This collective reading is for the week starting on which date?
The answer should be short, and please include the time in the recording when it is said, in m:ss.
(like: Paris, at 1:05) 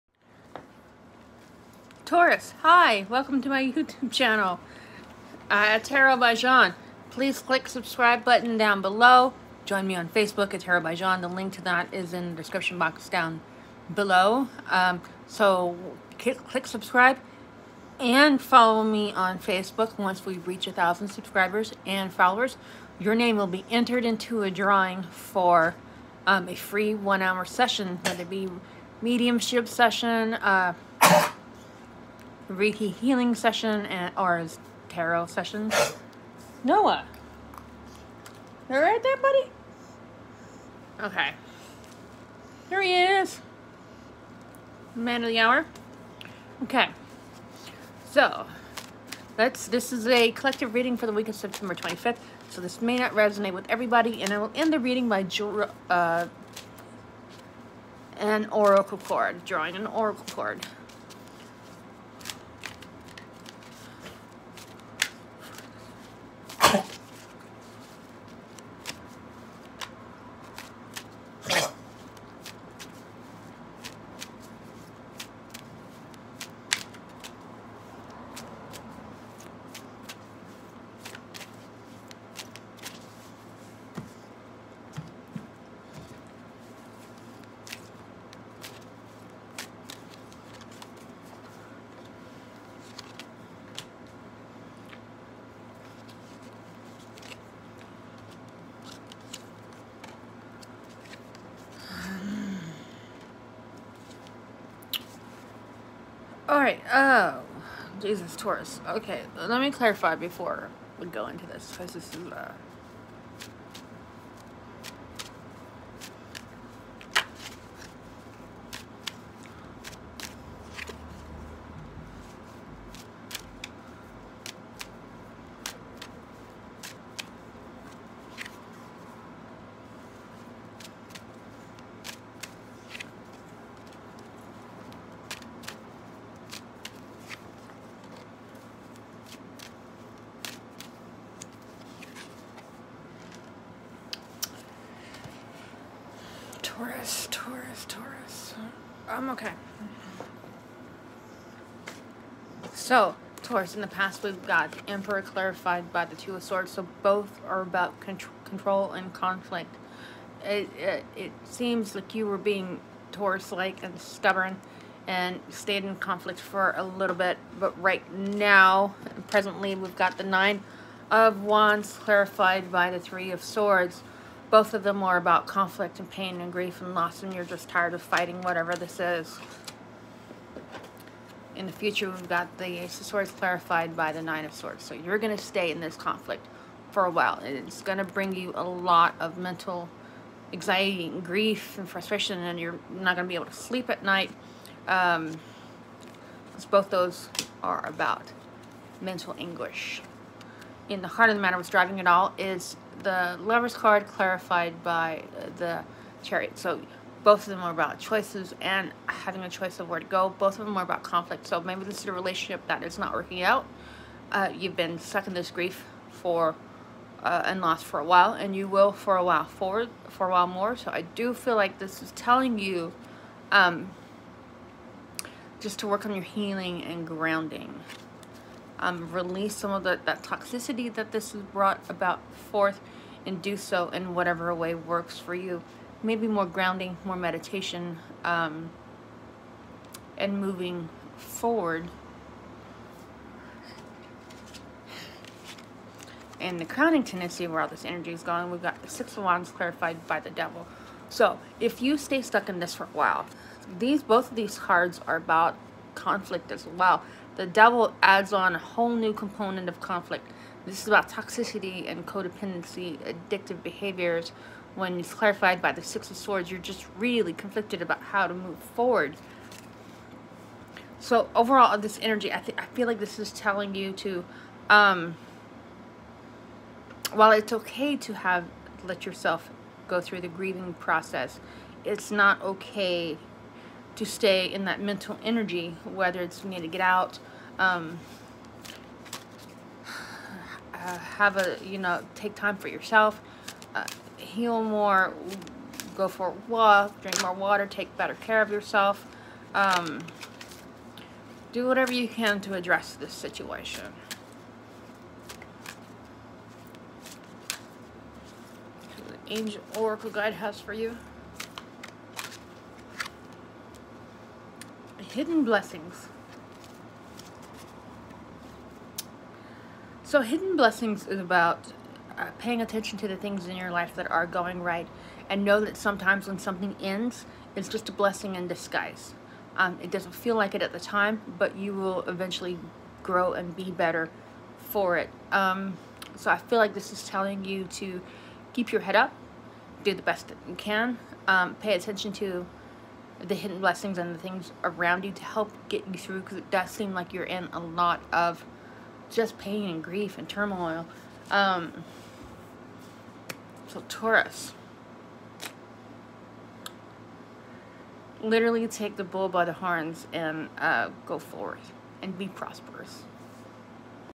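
September 25th, at 0:51.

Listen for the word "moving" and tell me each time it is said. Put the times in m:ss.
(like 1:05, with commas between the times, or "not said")
4:00.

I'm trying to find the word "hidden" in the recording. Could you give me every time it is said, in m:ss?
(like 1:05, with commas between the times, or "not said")
5:15, 5:20, 5:43.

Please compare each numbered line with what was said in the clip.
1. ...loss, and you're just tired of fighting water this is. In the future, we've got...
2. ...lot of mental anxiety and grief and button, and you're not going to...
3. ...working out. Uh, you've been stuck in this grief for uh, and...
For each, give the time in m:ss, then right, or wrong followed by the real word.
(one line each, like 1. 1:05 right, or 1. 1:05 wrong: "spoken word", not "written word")
1. 2:56 wrong: "whatever", not "water"
2. 3:08 wrong: "frustration", not "button"
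3. 3:33 right.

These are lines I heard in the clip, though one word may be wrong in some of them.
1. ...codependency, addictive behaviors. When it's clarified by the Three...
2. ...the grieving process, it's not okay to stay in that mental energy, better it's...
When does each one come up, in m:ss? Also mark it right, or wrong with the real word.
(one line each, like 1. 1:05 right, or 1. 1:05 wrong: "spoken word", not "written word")
1. 4:22 wrong: "Six", not "Three"
2. 4:40 wrong: "whether", not "better".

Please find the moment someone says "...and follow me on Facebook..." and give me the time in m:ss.
0:17.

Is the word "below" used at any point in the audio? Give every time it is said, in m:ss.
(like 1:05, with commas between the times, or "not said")
0:08, 0:13.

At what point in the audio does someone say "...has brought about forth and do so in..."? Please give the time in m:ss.
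3:51.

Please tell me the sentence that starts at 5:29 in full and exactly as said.
Um, it doesn't feel like it at the time, but you will eventually grow and be better for it.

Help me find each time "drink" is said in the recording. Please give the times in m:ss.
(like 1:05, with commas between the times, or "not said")
4:57.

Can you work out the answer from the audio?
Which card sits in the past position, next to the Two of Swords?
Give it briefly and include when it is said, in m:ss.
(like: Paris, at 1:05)
The Emperor, at 2:34.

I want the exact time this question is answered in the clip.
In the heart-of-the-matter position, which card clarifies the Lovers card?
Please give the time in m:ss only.
3:25.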